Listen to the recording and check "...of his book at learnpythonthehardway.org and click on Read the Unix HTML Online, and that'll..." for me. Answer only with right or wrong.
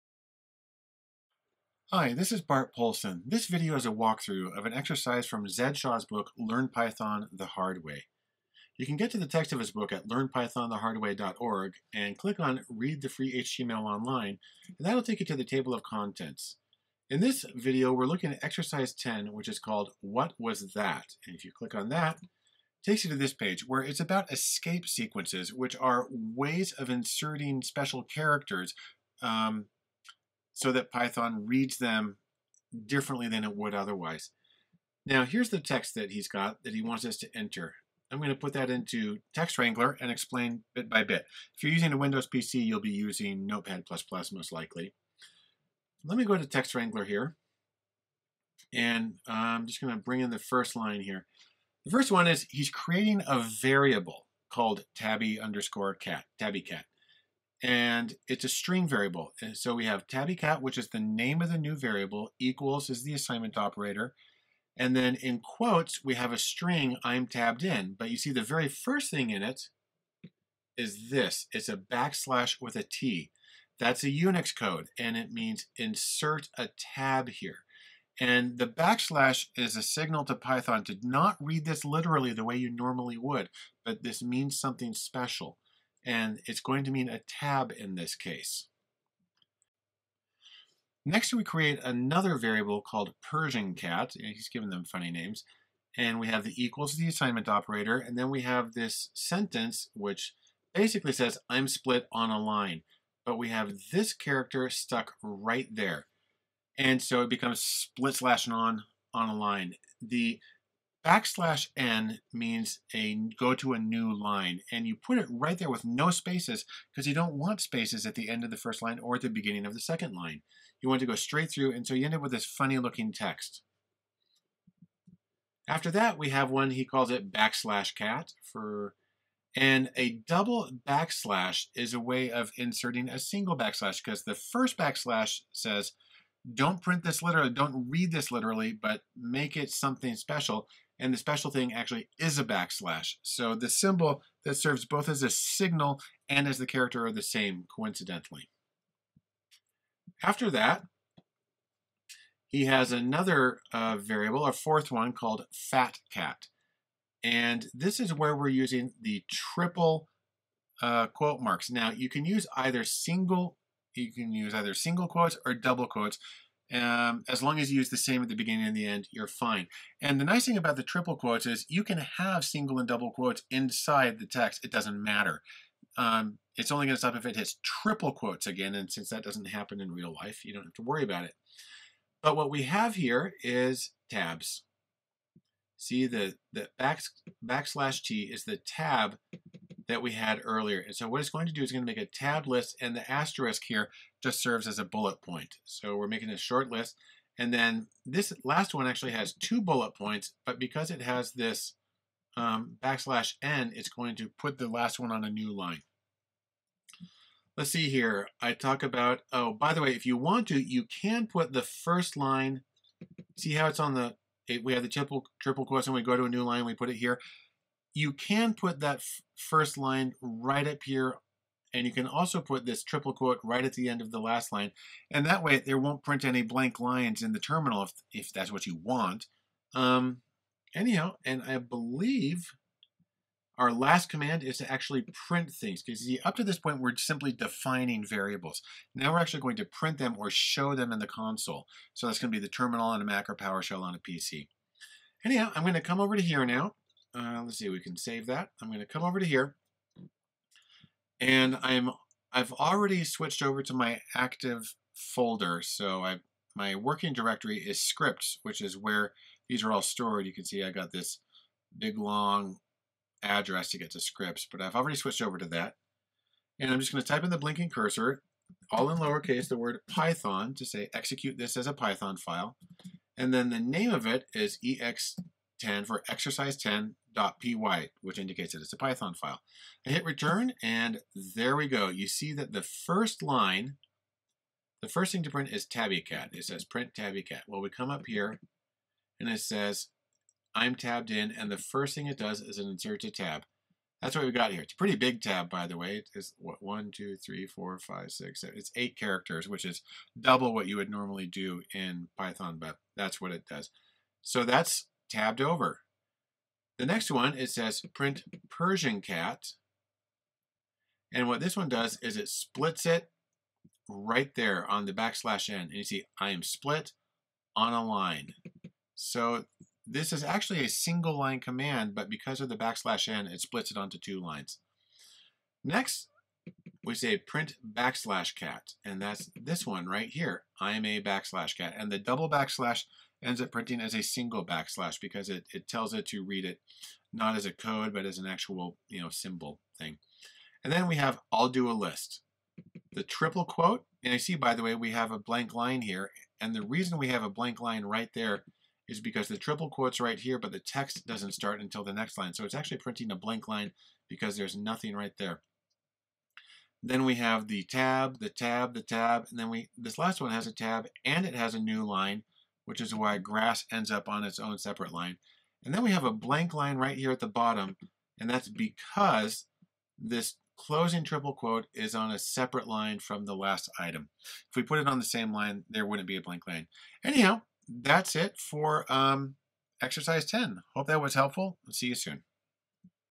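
wrong.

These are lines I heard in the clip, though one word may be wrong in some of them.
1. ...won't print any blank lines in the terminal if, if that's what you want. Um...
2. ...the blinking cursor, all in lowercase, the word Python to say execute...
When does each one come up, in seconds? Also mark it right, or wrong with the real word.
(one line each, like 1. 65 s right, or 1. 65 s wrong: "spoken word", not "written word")
1. 225 s right
2. 267 s right.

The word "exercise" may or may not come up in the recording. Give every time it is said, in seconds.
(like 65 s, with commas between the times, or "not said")
4 s, 18 s, 276 s, 379 s.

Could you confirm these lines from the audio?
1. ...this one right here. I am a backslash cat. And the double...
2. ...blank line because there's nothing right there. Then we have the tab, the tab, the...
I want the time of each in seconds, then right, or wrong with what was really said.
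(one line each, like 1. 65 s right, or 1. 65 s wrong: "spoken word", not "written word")
1. 329 s right
2. 353 s right.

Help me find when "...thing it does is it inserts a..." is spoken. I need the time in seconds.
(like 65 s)
291 s.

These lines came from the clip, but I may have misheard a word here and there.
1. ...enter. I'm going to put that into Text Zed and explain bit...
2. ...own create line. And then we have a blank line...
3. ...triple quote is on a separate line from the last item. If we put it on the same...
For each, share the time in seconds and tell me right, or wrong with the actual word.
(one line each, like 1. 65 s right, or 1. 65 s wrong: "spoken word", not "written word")
1. 37 s wrong: "Wrangler", not "Zed"
2. 364 s wrong: "separate", not "create"
3. 371 s right.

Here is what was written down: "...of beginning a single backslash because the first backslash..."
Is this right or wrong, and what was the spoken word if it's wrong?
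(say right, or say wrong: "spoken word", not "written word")
wrong: "inserting", not "beginning".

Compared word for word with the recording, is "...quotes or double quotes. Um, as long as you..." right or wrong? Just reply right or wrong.
right.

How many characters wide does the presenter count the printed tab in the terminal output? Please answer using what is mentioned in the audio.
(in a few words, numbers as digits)
8.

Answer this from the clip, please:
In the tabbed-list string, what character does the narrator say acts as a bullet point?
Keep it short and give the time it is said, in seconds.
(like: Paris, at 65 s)
The asterisk, at 193 s.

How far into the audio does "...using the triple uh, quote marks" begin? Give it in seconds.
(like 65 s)
158 s.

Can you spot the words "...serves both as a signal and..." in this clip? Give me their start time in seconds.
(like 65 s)
144 s.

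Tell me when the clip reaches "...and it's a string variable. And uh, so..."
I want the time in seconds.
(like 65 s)
57 s.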